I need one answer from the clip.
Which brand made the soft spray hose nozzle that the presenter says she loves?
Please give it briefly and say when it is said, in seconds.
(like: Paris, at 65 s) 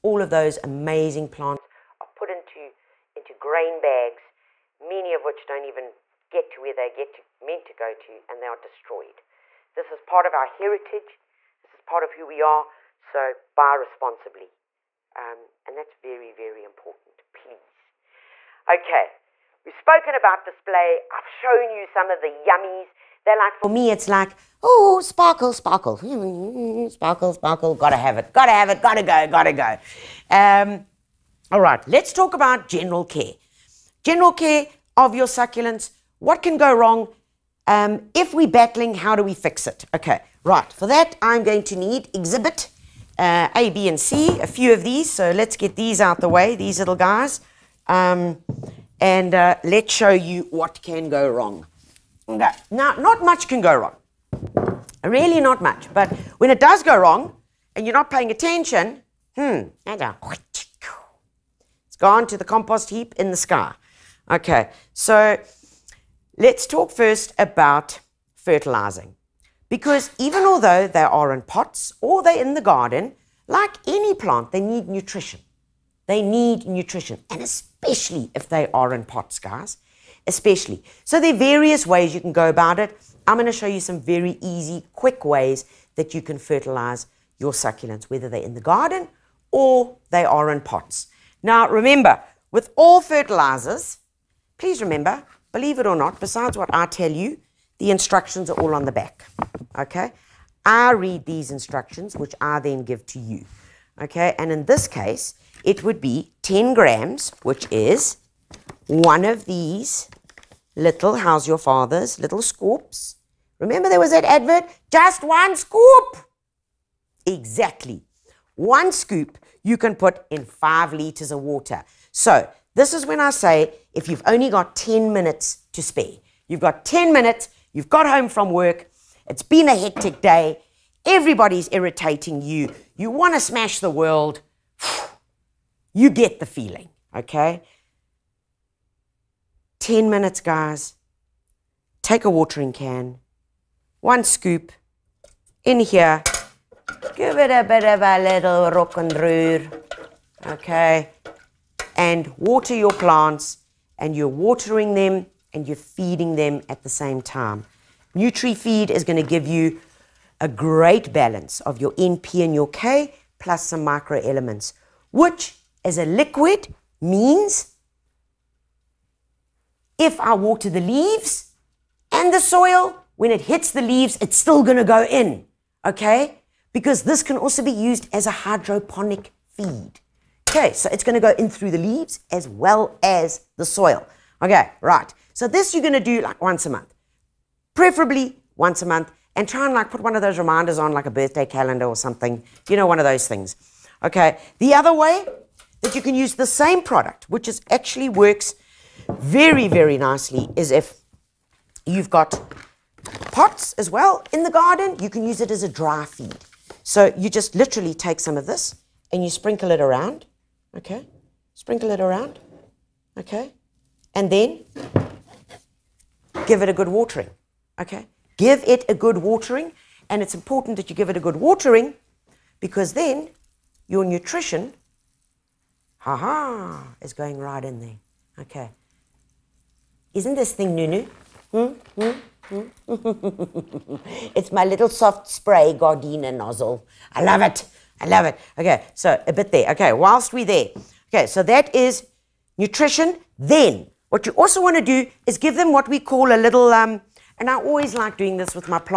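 Gardena, at 235 s.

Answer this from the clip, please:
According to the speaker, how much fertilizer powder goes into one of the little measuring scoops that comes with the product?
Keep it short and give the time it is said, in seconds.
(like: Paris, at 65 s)
10 grams, at 106 s.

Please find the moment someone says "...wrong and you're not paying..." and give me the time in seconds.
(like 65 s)
56 s.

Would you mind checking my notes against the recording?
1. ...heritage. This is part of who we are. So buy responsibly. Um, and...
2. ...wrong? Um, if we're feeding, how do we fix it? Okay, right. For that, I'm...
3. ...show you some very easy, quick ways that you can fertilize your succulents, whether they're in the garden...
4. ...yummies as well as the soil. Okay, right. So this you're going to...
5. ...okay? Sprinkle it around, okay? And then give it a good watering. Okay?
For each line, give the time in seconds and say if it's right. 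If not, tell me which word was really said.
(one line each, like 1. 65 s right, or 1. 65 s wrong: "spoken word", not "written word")
1. 10 s right
2. 36 s wrong: "battling", not "feeding"
3. 83 s right
4. 181 s wrong: "leaves", not "yummies"
5. 210 s right.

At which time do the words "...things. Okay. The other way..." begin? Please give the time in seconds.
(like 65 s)
193 s.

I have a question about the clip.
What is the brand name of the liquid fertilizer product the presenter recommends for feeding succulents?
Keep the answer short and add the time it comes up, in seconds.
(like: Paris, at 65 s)
NutriFeed, at 158 s.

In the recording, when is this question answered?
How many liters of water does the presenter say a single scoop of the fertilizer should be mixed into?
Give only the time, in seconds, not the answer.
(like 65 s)
120 s.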